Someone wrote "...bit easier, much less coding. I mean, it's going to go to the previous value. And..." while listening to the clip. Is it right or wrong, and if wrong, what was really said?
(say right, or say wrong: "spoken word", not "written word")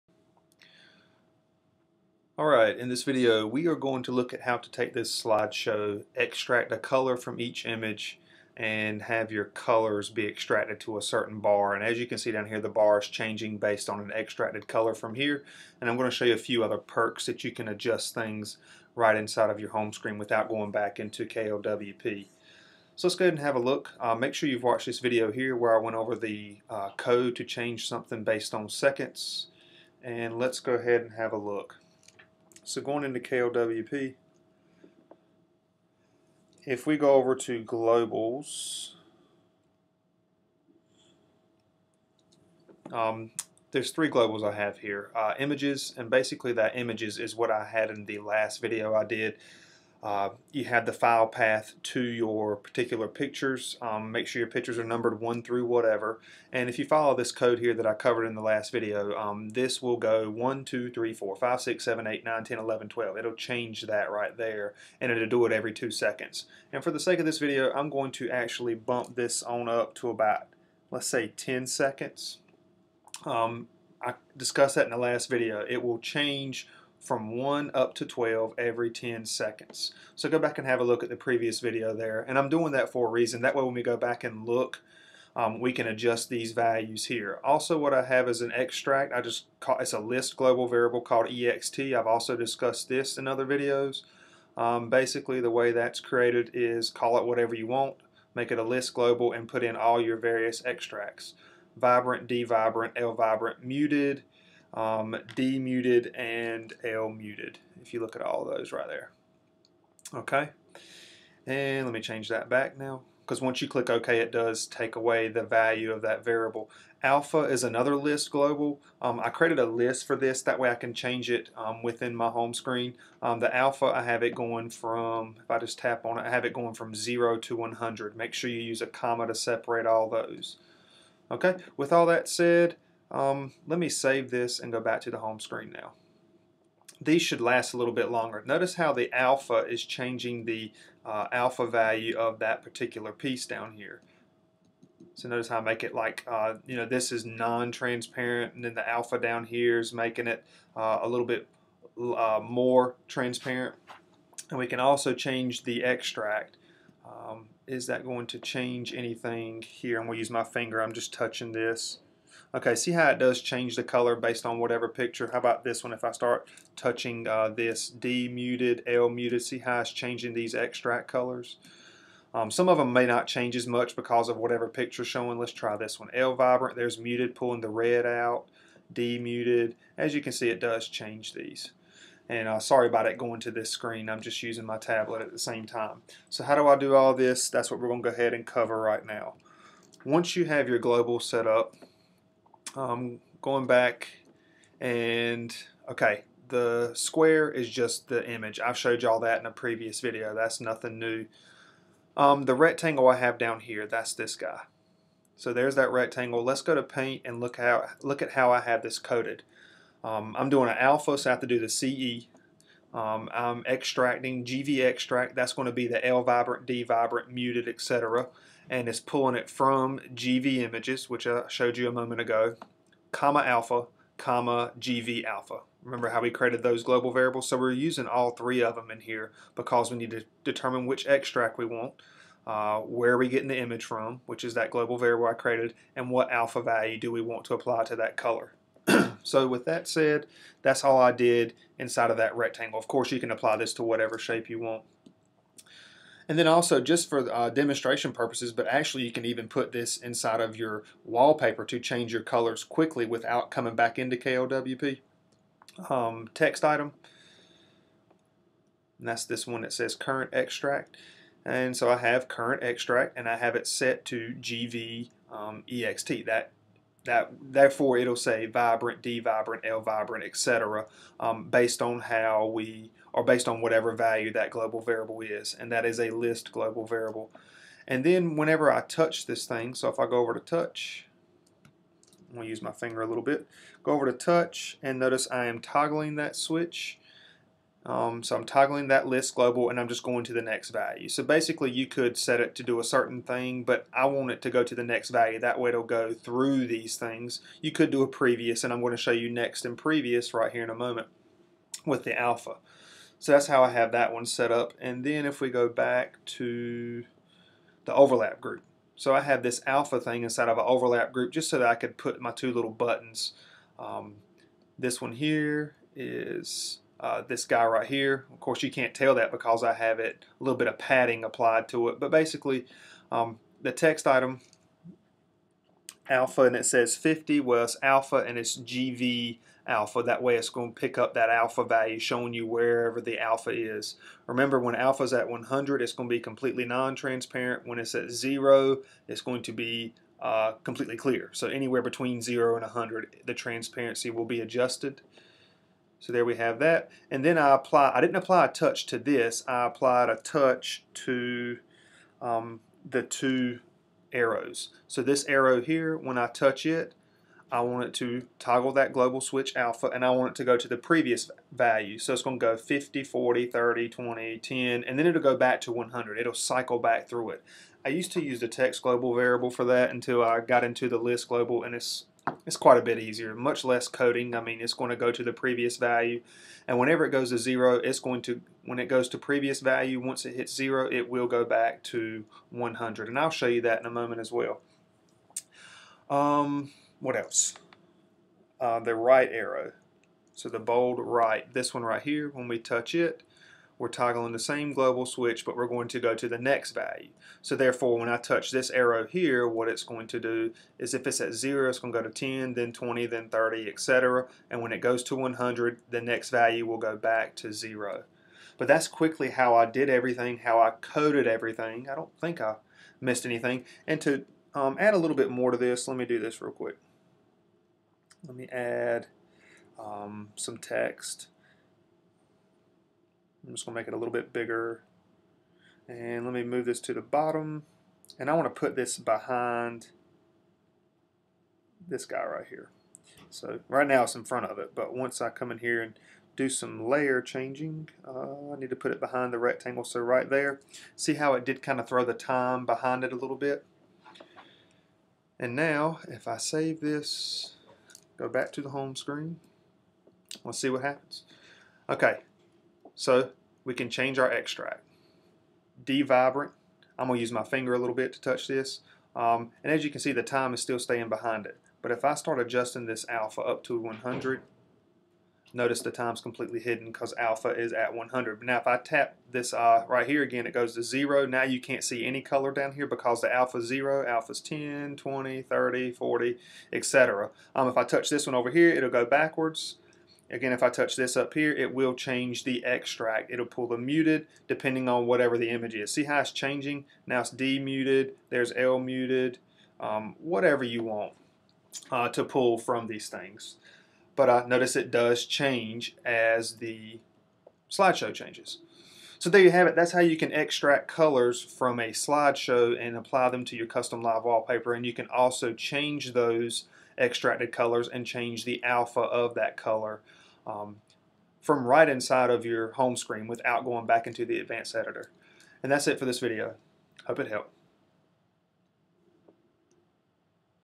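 right.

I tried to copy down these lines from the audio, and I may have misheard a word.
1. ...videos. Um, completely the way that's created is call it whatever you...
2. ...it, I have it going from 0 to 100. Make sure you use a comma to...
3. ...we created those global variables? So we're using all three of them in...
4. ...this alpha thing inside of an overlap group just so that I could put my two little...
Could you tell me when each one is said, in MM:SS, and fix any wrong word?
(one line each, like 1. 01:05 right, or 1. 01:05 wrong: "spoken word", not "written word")
1. 01:33 wrong: "basically", not "completely"
2. 02:06 right
3. 03:46 right
4. 05:09 right.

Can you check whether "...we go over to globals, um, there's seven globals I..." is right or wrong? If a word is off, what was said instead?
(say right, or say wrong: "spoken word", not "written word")
wrong: "three", not "seven".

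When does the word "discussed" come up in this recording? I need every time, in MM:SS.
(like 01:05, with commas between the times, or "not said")
01:14, 01:32.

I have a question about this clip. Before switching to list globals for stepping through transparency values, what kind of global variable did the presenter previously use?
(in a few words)
text global variable.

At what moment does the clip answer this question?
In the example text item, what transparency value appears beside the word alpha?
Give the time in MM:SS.
05:26.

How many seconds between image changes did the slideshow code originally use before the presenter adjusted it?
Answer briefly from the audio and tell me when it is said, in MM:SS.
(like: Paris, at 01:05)
2 seconds, at 01:05.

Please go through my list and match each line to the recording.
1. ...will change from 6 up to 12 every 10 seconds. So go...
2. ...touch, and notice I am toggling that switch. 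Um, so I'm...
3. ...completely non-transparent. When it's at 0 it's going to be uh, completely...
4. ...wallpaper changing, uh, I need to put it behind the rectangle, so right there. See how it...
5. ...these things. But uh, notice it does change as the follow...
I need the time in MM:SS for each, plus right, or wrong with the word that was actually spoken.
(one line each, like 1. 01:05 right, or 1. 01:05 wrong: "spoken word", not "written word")
1. 01:15 wrong: "1", not "6"
2. 04:44 right
3. 05:36 right
4. 07:16 wrong: "layer", not "wallpaper"
5. 08:12 wrong: "slideshow", not "follow".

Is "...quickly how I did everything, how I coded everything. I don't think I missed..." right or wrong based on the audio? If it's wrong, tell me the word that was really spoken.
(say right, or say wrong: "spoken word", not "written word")
right.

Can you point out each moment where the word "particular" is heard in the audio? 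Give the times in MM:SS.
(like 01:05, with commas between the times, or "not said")
00:52, 02:22.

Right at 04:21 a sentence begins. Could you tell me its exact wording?
And so I have current extract and I have it set to GV um, EXT.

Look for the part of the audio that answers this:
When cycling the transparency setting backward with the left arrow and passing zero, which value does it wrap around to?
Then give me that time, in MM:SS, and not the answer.
06:20.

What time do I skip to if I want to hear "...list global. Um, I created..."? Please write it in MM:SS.
01:57.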